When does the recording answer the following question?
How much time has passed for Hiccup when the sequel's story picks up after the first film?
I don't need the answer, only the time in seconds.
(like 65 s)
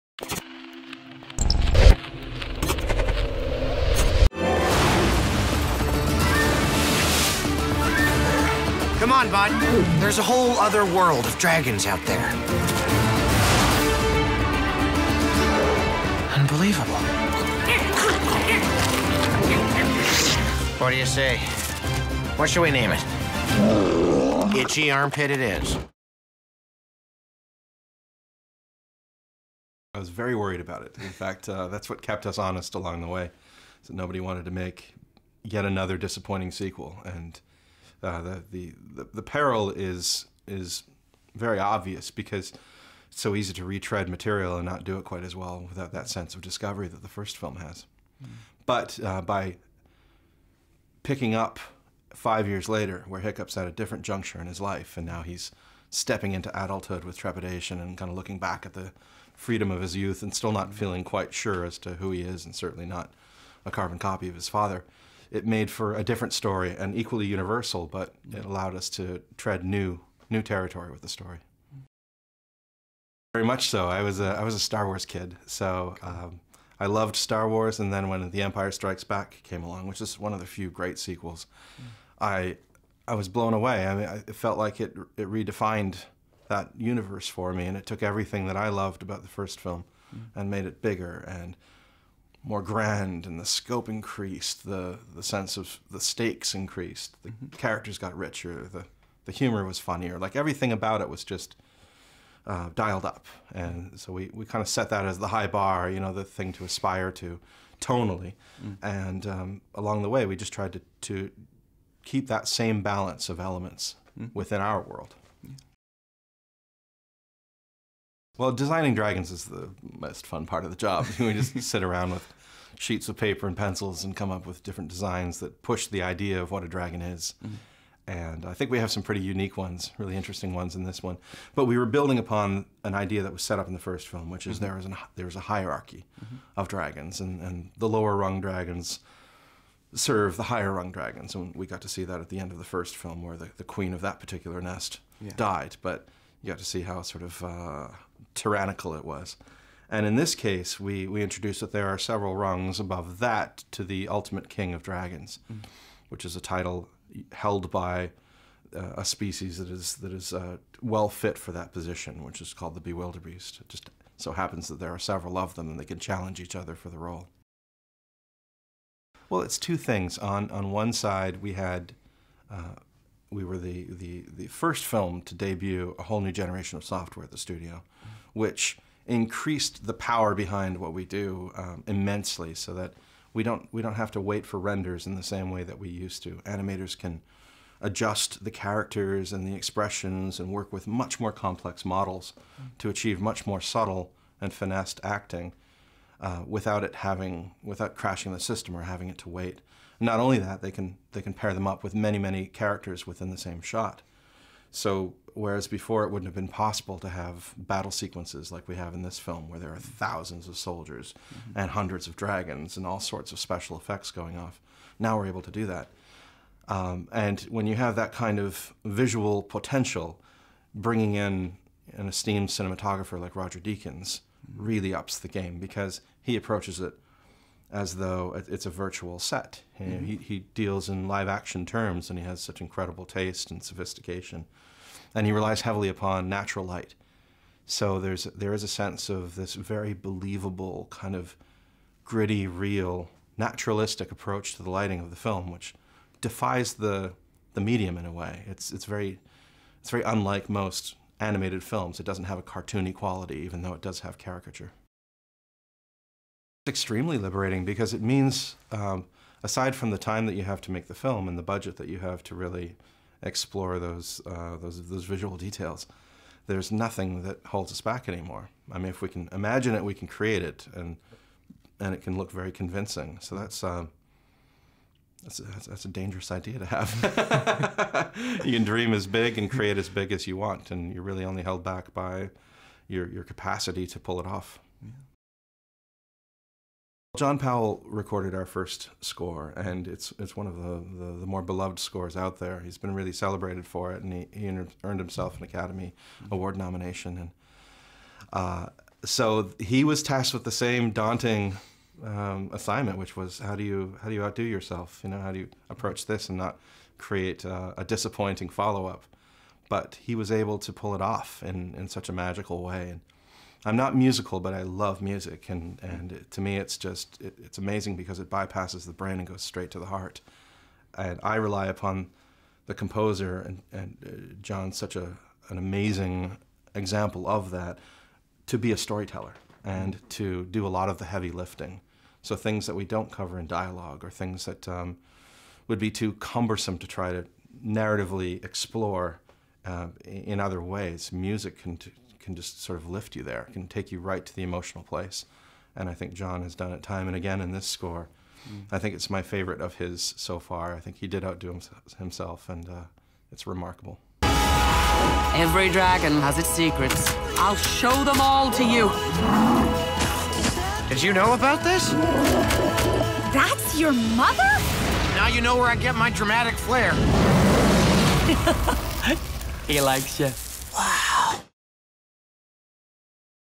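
52 s.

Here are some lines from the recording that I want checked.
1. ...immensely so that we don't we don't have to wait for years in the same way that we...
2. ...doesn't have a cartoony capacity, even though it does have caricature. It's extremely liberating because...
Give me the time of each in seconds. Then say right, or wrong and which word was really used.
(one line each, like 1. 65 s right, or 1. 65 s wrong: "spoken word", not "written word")
1. 181 s wrong: "renders", not "years"
2. 252 s wrong: "quality", not "capacity".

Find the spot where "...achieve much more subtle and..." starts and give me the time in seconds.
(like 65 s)
192 s.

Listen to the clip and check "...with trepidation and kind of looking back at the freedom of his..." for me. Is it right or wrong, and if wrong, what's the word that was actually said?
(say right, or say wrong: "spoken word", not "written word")
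right.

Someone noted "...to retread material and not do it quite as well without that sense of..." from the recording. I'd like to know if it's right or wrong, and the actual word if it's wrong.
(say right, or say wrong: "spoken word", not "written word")
right.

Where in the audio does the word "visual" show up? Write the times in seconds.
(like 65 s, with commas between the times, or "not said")
218 s, 265 s.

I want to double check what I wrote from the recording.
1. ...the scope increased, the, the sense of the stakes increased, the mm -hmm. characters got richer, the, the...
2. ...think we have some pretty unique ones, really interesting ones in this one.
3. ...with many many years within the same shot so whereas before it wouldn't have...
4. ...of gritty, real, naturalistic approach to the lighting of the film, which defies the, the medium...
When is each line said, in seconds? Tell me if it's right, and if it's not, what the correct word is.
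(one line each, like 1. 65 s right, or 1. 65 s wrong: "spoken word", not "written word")
1. 93 s right
2. 128 s right
3. 201 s wrong: "characters", not "years"
4. 241 s right.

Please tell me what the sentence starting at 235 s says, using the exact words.
And he relies heavily upon natural light.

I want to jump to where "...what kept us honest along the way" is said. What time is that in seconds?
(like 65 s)
31 s.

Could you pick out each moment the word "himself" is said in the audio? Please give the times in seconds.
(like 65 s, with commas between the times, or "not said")
295 s, 351 s.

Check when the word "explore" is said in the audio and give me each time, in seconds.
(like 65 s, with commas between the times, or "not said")
263 s, 338 s.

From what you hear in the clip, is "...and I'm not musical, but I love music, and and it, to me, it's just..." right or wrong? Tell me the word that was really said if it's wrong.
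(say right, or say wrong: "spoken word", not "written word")
right.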